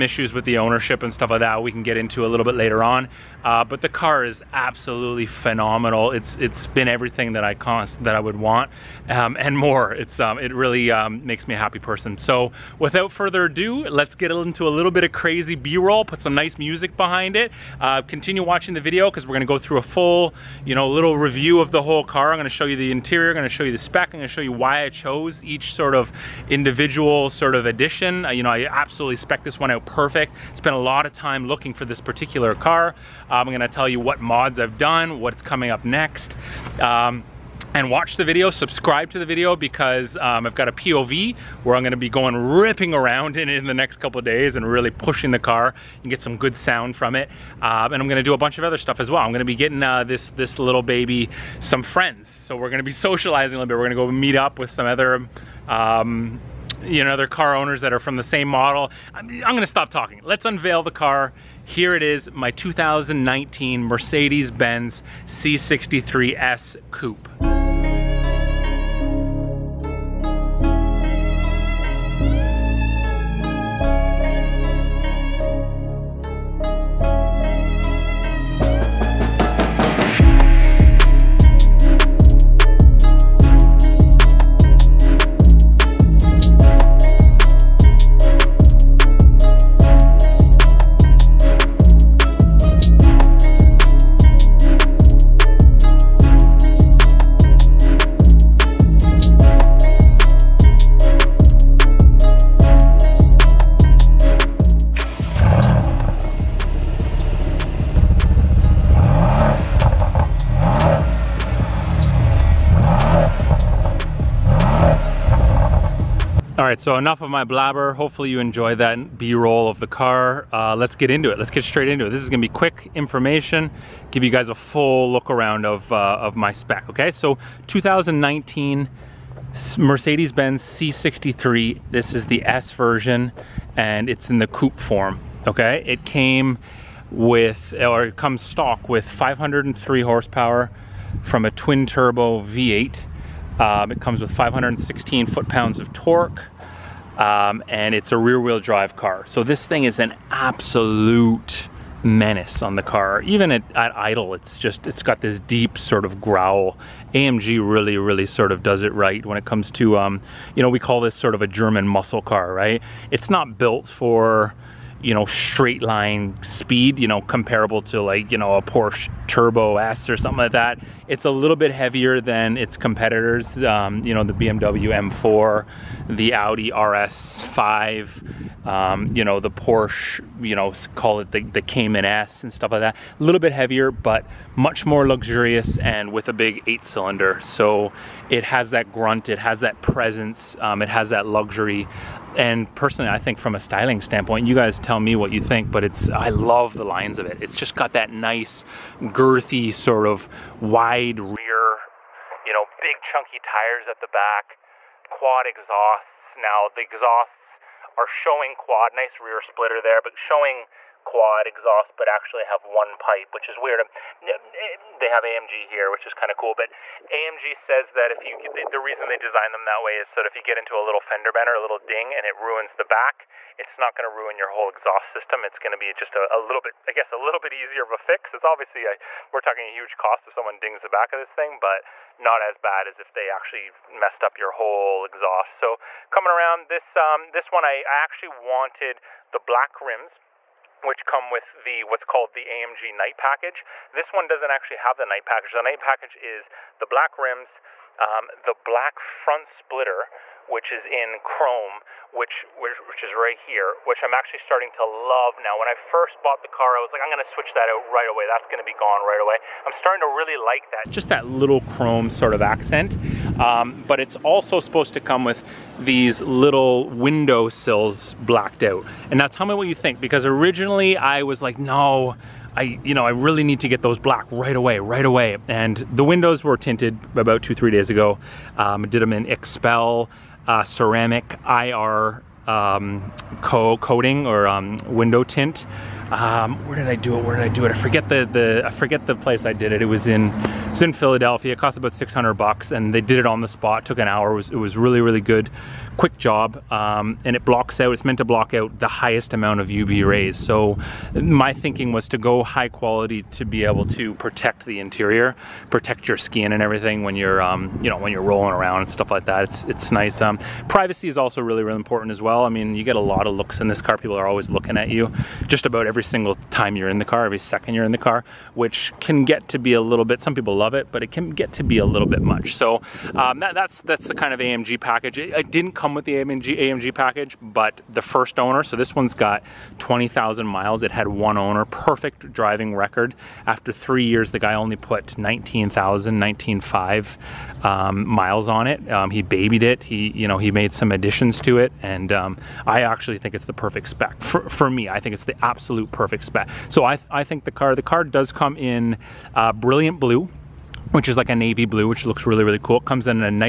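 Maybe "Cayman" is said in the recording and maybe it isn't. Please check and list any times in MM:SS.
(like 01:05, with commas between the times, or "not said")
03:01.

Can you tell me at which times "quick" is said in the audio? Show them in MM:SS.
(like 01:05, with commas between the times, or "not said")
02:02, 04:55.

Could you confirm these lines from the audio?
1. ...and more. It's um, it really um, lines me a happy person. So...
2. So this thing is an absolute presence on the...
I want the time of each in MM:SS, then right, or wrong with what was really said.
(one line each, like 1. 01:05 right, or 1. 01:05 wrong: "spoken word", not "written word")
1. 00:09 wrong: "makes", not "lines"
2. 02:29 wrong: "menace", not "presence".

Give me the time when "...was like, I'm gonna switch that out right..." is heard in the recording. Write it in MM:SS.
04:16.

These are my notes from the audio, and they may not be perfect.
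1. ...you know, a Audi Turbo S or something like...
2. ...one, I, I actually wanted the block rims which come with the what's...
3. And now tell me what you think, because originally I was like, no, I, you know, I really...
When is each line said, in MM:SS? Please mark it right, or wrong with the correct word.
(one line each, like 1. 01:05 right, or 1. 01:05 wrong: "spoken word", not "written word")
1. 02:48 wrong: "Porsche", not "Audi"
2. 03:57 wrong: "black", not "block"
3. 04:29 right.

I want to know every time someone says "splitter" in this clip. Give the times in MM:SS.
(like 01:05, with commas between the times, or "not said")
03:29, 04:09.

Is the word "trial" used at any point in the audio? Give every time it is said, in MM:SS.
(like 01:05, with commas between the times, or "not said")
not said.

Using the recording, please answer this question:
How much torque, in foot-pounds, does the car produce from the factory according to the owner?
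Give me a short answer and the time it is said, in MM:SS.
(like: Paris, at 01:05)
516, at 02:24.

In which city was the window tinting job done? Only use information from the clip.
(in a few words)
Philadelphia.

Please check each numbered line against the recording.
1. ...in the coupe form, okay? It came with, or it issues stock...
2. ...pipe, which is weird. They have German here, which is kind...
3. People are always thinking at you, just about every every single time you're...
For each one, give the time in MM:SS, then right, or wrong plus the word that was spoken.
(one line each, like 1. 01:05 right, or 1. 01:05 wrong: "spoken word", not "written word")
1. 02:14 wrong: "comes", not "issues"
2. 03:32 wrong: "AMG", not "German"
3. 05:13 wrong: "looking", not "thinking".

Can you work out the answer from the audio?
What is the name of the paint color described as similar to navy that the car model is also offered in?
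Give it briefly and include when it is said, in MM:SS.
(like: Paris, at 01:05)
brilliant blue, at 05:49.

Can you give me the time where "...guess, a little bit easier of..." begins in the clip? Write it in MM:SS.
03:46.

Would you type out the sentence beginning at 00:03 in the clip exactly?
Uh, but the car is absolutely phenomenal.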